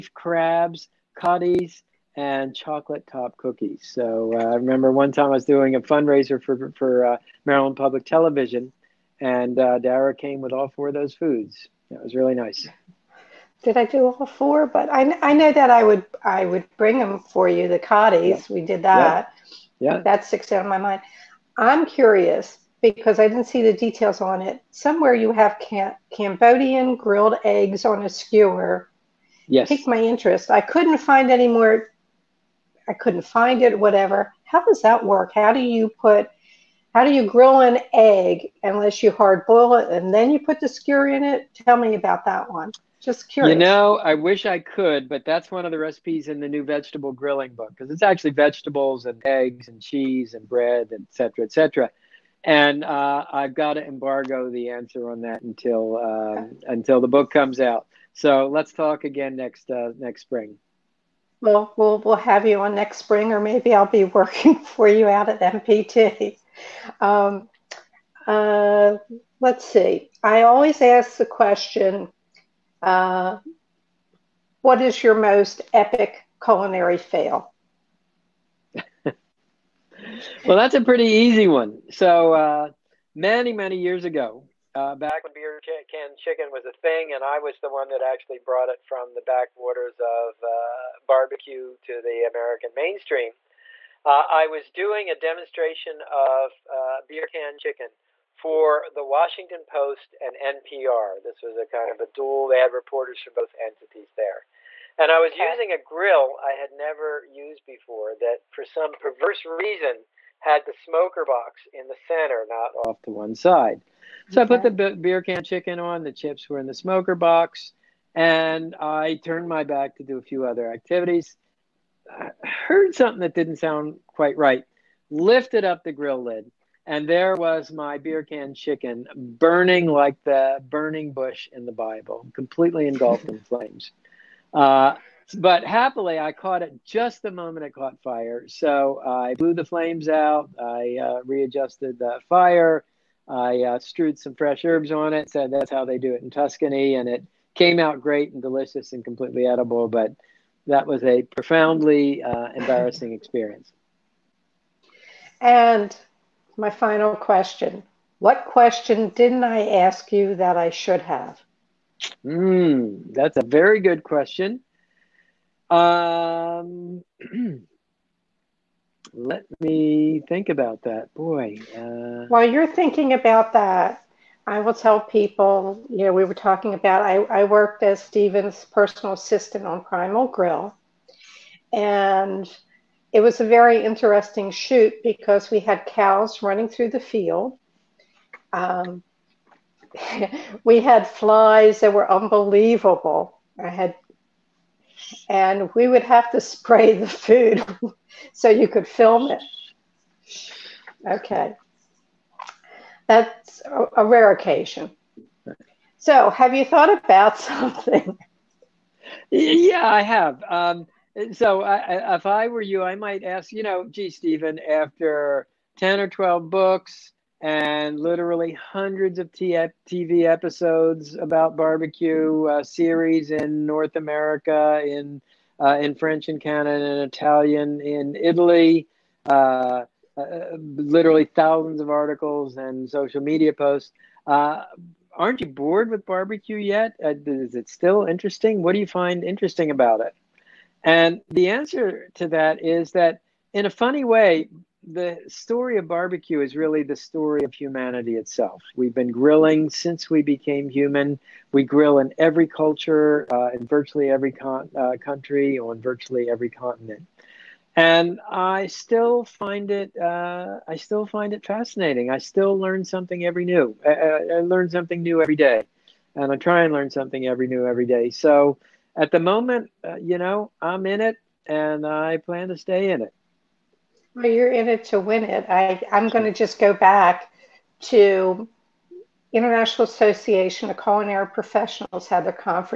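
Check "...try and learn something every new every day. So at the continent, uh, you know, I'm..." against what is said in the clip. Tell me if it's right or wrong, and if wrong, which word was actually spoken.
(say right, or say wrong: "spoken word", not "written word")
wrong: "moment", not "continent".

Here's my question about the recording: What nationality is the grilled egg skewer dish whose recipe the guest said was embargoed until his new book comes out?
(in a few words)
Cambodian.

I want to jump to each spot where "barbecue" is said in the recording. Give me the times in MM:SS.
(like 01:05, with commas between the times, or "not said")
01:31, 03:41, 03:56, 04:05.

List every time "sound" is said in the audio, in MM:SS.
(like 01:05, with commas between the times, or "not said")
02:03.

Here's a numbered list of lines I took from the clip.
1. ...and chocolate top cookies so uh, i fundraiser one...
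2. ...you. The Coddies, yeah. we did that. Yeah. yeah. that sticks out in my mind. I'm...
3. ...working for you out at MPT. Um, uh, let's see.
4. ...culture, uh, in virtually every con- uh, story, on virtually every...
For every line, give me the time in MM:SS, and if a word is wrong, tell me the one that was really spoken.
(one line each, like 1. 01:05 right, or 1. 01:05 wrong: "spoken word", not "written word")
1. 00:02 wrong: "remember", not "fundraiser"
2. 00:17 right
3. 01:04 right
4. 04:12 wrong: "country", not "story".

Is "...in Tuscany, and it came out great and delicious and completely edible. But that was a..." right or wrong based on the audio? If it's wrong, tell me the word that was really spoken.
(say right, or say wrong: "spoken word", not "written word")
right.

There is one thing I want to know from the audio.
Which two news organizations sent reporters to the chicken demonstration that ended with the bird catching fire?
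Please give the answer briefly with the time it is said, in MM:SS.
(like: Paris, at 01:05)
Washington Post and NPR, at 01:39.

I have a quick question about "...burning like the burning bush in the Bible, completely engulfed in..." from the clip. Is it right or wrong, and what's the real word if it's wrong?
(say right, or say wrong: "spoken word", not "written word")
right.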